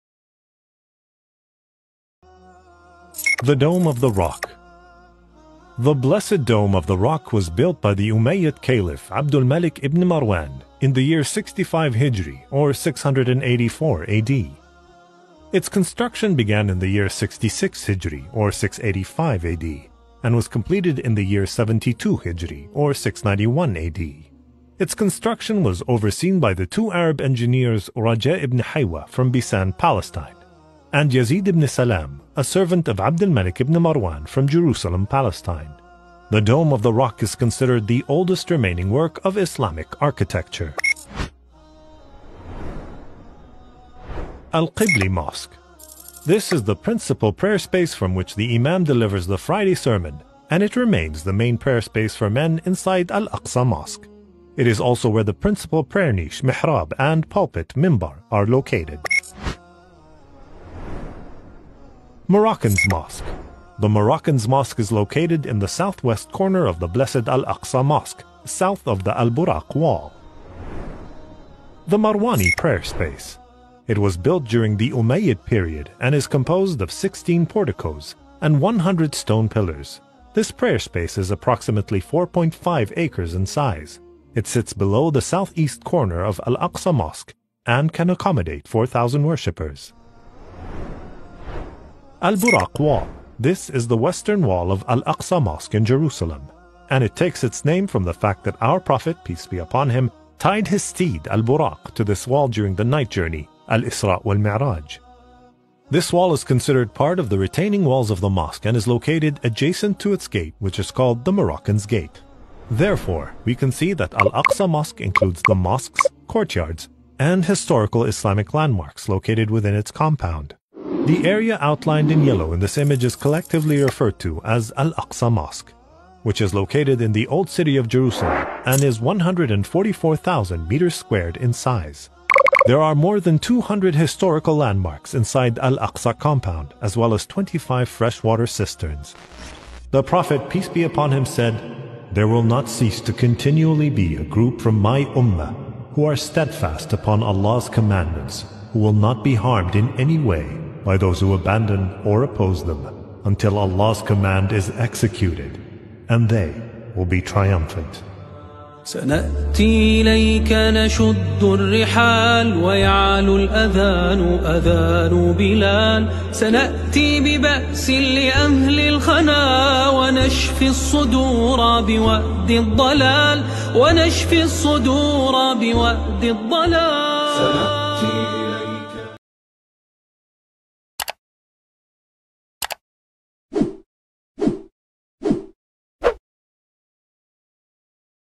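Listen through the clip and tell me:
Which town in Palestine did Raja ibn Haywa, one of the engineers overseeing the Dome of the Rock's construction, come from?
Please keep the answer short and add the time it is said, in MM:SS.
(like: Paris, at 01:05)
Bisan, at 00:29.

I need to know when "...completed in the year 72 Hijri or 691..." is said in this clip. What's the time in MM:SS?
00:20.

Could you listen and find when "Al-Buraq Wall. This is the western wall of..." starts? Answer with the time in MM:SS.
01:32.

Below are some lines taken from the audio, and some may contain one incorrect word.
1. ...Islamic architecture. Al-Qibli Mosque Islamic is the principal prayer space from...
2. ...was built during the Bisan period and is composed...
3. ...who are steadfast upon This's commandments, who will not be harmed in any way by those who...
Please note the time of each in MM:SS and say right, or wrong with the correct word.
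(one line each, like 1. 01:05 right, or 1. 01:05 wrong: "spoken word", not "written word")
1. 00:39 wrong: "This", not "Islamic"
2. 01:13 wrong: "Umayyad", not "Bisan"
3. 02:25 wrong: "Allah", not "This".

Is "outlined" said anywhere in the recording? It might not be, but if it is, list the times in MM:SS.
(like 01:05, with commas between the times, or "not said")
02:01.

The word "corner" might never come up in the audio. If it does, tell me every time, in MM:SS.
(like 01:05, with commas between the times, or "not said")
01:06, 01:25.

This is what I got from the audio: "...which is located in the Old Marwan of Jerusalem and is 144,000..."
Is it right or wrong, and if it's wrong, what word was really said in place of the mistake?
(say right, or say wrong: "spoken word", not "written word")
wrong: "City", not "Marwan".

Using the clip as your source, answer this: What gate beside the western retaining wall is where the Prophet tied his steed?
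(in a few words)
Moroccan's Gate.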